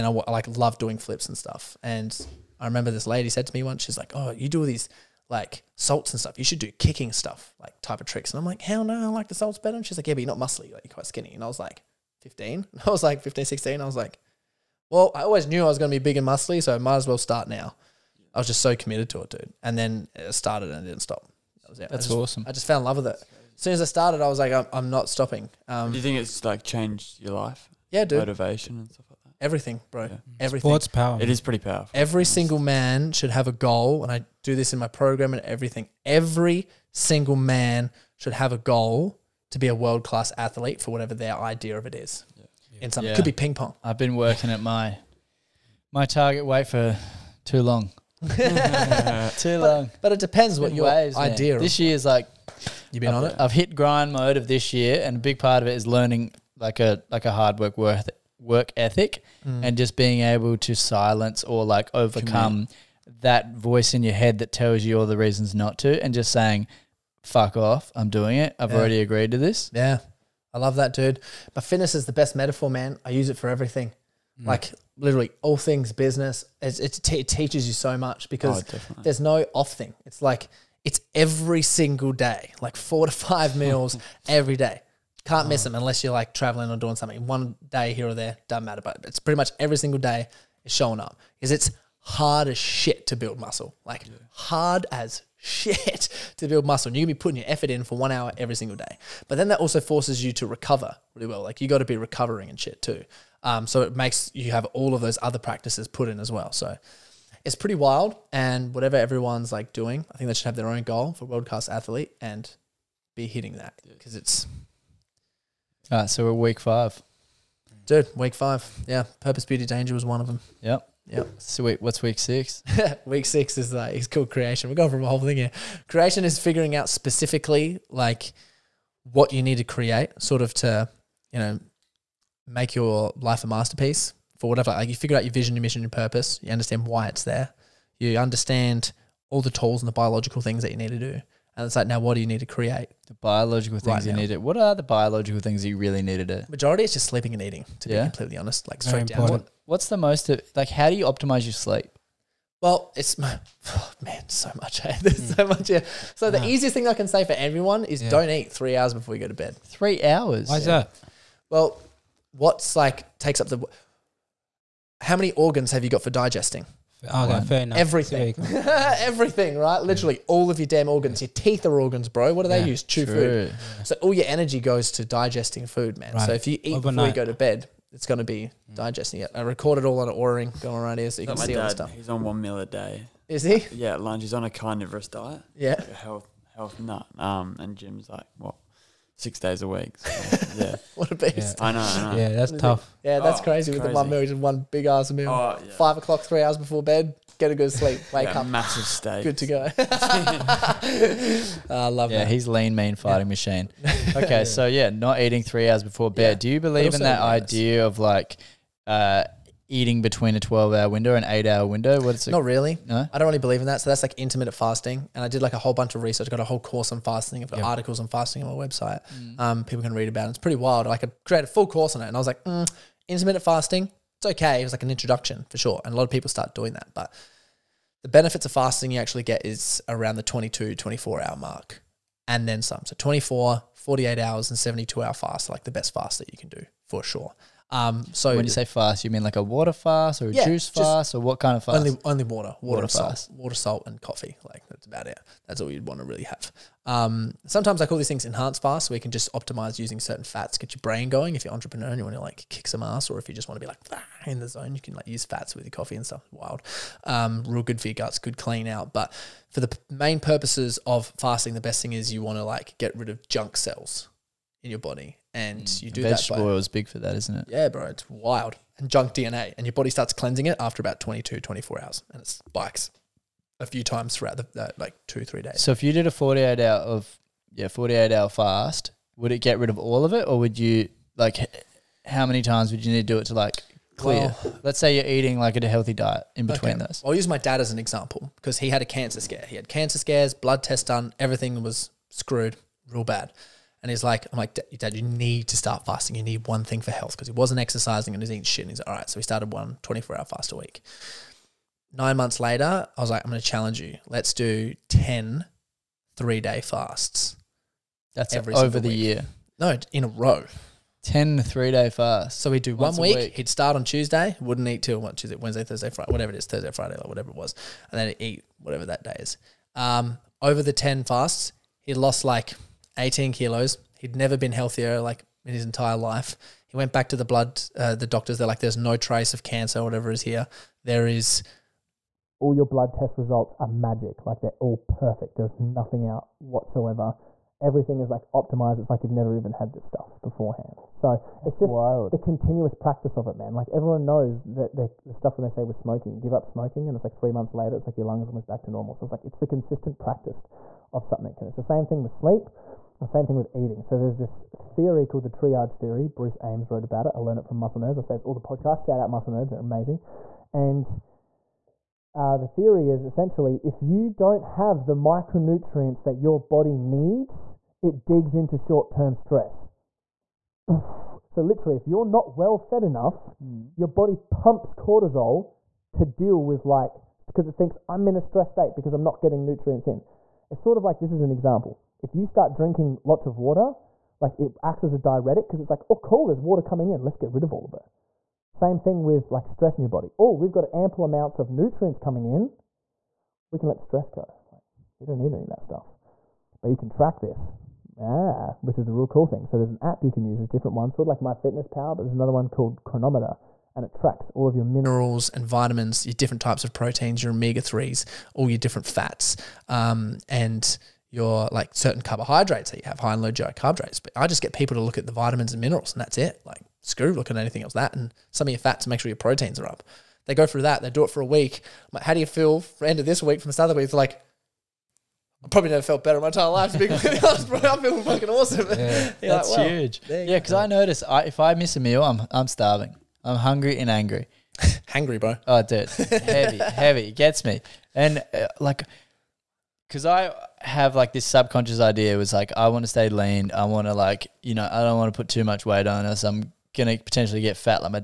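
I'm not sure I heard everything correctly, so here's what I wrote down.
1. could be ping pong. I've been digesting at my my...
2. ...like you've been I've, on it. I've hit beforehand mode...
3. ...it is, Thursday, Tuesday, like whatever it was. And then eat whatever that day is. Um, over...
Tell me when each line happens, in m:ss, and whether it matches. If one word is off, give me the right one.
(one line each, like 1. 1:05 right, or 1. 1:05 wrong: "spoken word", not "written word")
1. 0:43 wrong: "working", not "digesting"
2. 0:52 wrong: "grind", not "beforehand"
3. 5:16 wrong: "Friday", not "Tuesday".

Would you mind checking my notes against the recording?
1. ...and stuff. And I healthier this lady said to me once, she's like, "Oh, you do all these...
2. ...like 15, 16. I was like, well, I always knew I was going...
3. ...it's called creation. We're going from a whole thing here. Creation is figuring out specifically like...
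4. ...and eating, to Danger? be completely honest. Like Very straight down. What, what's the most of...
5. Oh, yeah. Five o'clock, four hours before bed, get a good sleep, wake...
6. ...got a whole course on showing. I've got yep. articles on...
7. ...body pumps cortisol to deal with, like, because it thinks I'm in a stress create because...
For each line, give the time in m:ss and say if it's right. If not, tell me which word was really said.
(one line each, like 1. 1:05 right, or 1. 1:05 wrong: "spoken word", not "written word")
1. 0:01 wrong: "remember", not "healthier"
2. 0:13 right
3. 2:03 right
4. 2:27 wrong: "Yeah", not "Danger"
5. 3:15 wrong: "three", not "four"
6. 3:36 wrong: "fasting", not "showing"
7. 6:13 wrong: "state", not "create".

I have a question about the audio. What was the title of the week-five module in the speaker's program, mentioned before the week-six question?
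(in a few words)
Purpose, Beauty, Danger.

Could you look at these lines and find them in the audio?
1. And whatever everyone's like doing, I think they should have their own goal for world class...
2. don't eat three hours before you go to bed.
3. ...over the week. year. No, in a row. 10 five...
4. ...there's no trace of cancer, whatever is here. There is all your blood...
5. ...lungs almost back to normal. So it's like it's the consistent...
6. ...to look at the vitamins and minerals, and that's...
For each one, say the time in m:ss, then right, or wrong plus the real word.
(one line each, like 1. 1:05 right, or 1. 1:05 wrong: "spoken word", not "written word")
1. 1:48 right
2. 2:38 right
3. 5:08 wrong: "three", not "five"
4. 5:28 right
5. 5:48 right
6. 6:54 right.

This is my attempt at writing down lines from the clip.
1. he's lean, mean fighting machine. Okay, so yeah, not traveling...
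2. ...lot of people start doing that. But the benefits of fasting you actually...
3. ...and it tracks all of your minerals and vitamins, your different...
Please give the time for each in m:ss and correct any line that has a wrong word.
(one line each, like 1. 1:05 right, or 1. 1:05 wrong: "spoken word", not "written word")
1. 3:22 wrong: "eating", not "traveling"
2. 3:45 right
3. 6:43 right.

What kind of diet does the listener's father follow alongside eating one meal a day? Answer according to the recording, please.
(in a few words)
Carnivorous diet.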